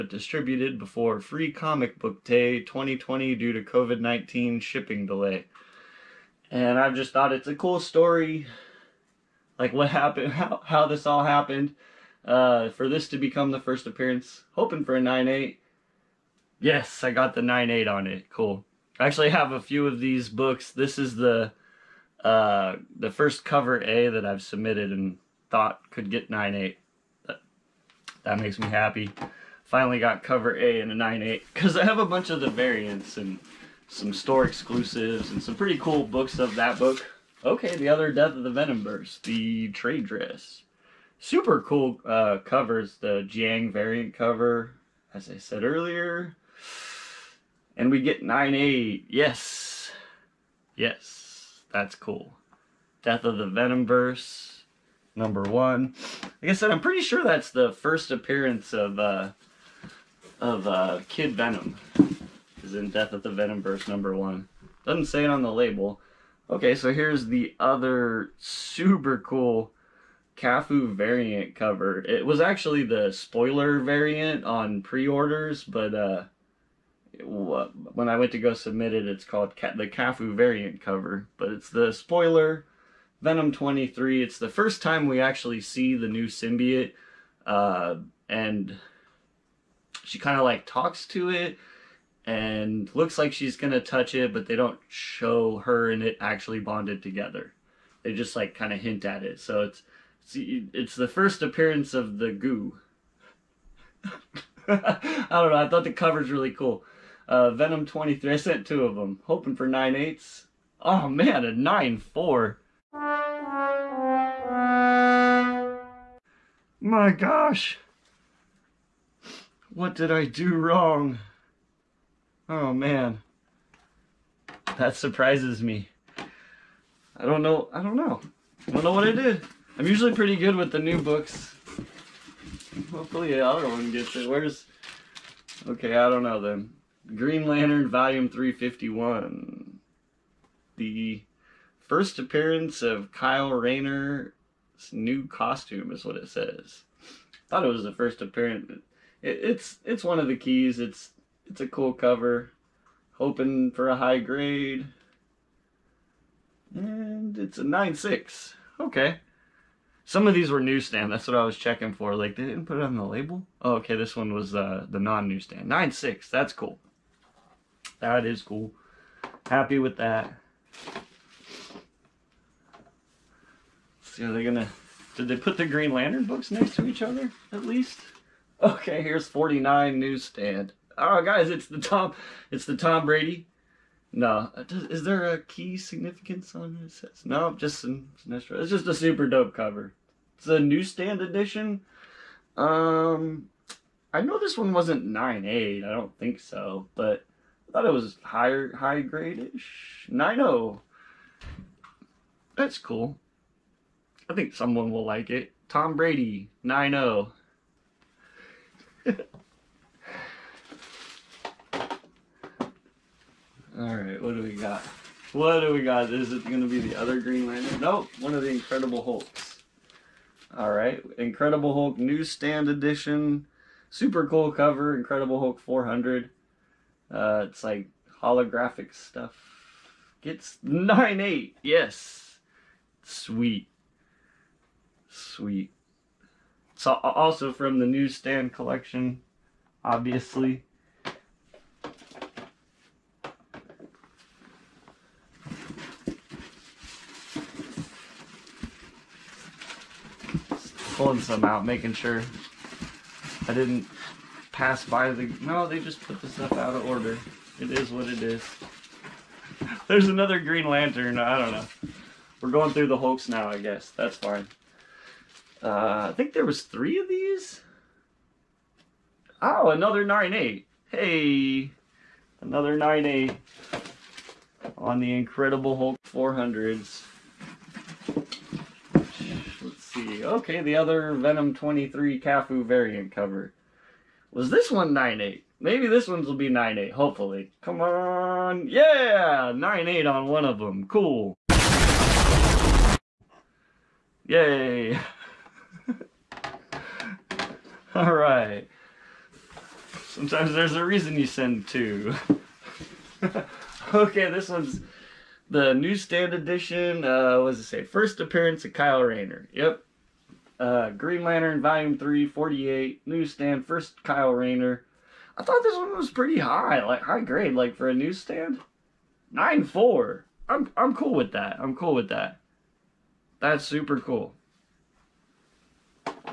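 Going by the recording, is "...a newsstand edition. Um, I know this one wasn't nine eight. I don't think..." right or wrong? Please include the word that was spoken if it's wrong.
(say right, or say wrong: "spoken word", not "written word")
right.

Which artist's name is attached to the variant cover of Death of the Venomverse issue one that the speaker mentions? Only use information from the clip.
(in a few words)
Jiang.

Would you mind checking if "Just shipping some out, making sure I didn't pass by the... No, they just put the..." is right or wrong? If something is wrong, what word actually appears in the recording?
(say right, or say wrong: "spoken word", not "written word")
wrong: "pulling", not "shipping".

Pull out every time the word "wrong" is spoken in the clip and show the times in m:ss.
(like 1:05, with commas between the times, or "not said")
2:00.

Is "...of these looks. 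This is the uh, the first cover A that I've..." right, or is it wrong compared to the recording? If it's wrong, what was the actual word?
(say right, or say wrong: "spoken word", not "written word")
wrong: "books", not "looks".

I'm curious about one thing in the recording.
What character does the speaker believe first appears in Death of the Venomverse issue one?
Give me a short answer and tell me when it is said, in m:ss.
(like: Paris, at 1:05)
Kid Venom, at 1:01.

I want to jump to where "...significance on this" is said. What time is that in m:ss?
3:05.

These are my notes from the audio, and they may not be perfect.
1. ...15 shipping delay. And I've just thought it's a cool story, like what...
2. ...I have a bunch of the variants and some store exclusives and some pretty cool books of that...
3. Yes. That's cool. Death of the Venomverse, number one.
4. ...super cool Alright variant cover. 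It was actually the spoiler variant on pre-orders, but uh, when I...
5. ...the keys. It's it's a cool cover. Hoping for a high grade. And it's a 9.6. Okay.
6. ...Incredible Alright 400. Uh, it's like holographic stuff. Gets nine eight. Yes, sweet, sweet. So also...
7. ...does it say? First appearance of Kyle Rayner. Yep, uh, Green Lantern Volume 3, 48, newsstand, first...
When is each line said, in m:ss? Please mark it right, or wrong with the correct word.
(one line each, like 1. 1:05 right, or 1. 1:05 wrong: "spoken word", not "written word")
1. 0:04 wrong: "19", not "15"
2. 0:31 right
3. 0:50 right
4. 1:08 wrong: "Cafu", not "Alright"
5. 2:30 right
6. 3:44 wrong: "Hulk", not "Alright"
7. 5:07 right.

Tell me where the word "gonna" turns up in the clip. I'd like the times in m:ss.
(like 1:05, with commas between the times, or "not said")
1:33, 2:54.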